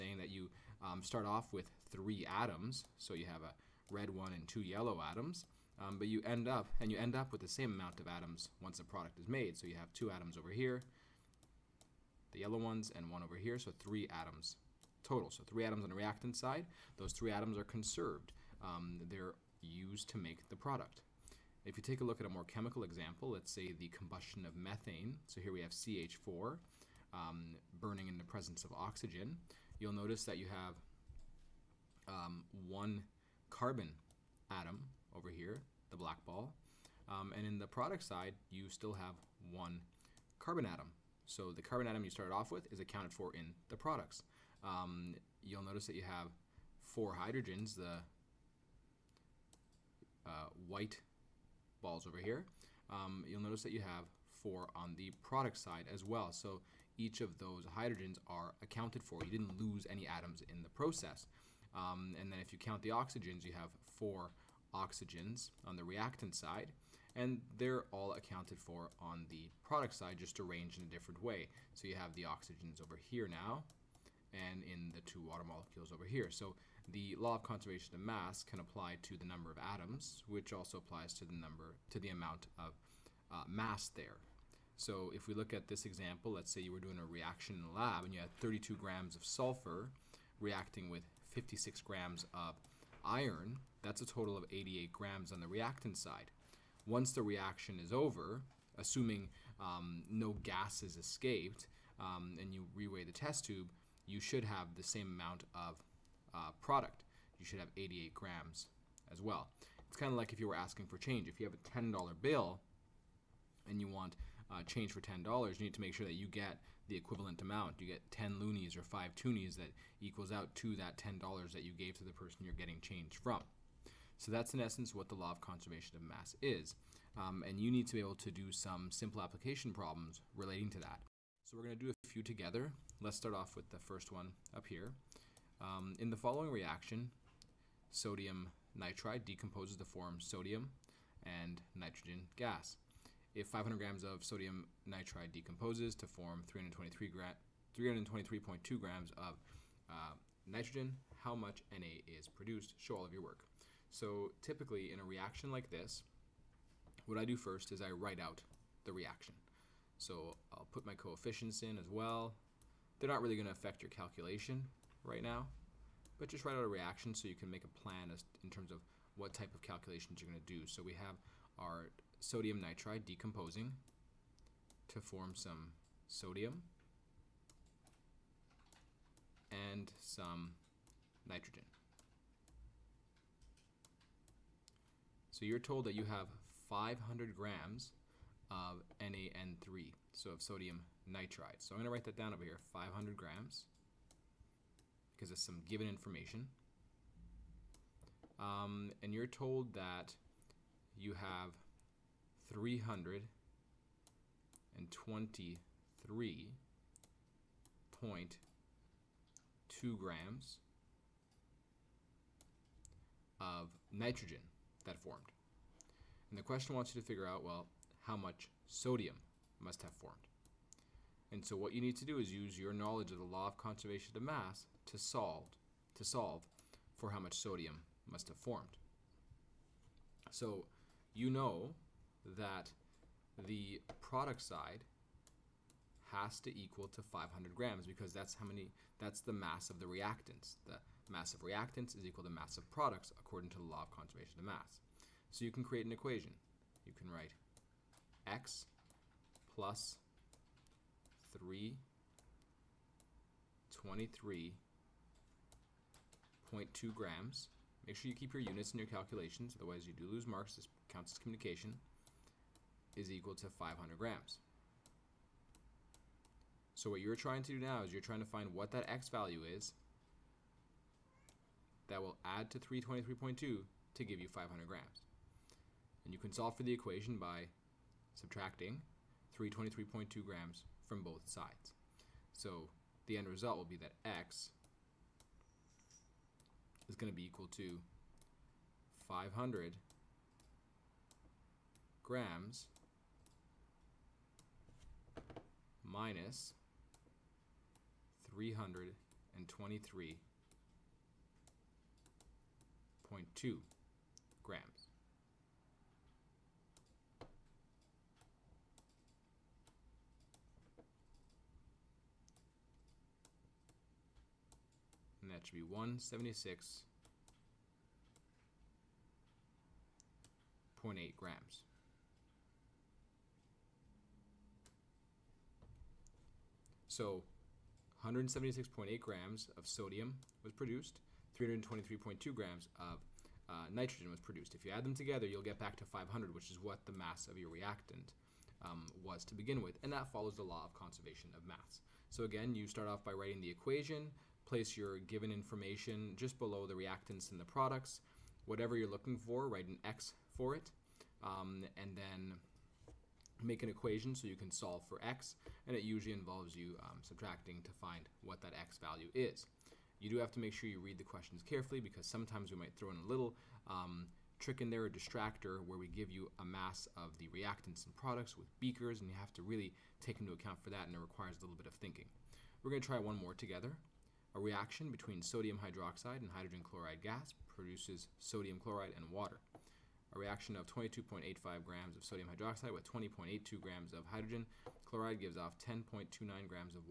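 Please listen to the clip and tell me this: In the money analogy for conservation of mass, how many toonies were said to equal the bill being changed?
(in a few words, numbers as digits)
5.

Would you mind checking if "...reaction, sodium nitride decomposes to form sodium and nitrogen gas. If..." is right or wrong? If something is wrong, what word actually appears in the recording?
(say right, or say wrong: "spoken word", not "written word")
right.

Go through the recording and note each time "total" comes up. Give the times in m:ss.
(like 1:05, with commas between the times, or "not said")
0:15, 1:34.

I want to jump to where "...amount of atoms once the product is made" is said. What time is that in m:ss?
0:07.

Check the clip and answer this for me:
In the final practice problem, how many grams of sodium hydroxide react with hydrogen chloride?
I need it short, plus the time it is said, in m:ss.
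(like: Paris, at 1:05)
22.85 grams, at 6:20.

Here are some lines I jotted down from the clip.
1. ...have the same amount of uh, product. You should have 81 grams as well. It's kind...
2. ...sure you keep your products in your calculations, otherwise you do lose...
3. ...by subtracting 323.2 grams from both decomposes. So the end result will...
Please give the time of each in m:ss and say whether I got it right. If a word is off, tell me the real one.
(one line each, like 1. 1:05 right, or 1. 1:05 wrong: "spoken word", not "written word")
1. 1:44 wrong: "88", not "81"
2. 4:17 wrong: "units", not "products"
3. 4:37 wrong: "sides", not "decomposes".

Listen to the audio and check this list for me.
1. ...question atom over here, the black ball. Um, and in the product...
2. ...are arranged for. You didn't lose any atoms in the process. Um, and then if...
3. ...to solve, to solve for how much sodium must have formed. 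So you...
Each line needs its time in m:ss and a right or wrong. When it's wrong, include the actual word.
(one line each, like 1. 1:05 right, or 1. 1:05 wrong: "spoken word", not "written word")
1. 0:33 wrong: "carbon", not "question"
2. 0:58 wrong: "accounted", not "arranged"
3. 3:44 right.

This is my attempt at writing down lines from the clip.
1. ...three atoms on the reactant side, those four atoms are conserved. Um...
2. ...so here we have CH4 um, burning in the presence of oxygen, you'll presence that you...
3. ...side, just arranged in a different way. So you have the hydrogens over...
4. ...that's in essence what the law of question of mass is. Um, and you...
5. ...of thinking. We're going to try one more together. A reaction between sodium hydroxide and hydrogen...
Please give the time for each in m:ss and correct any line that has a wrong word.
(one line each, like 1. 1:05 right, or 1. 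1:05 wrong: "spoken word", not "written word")
1. 0:15 wrong: "three", not "four"
2. 0:25 wrong: "notice", not "presence"
3. 1:09 wrong: "oxygens", not "hydrogens"
4. 2:04 wrong: "conservation", not "question"
5. 6:11 right.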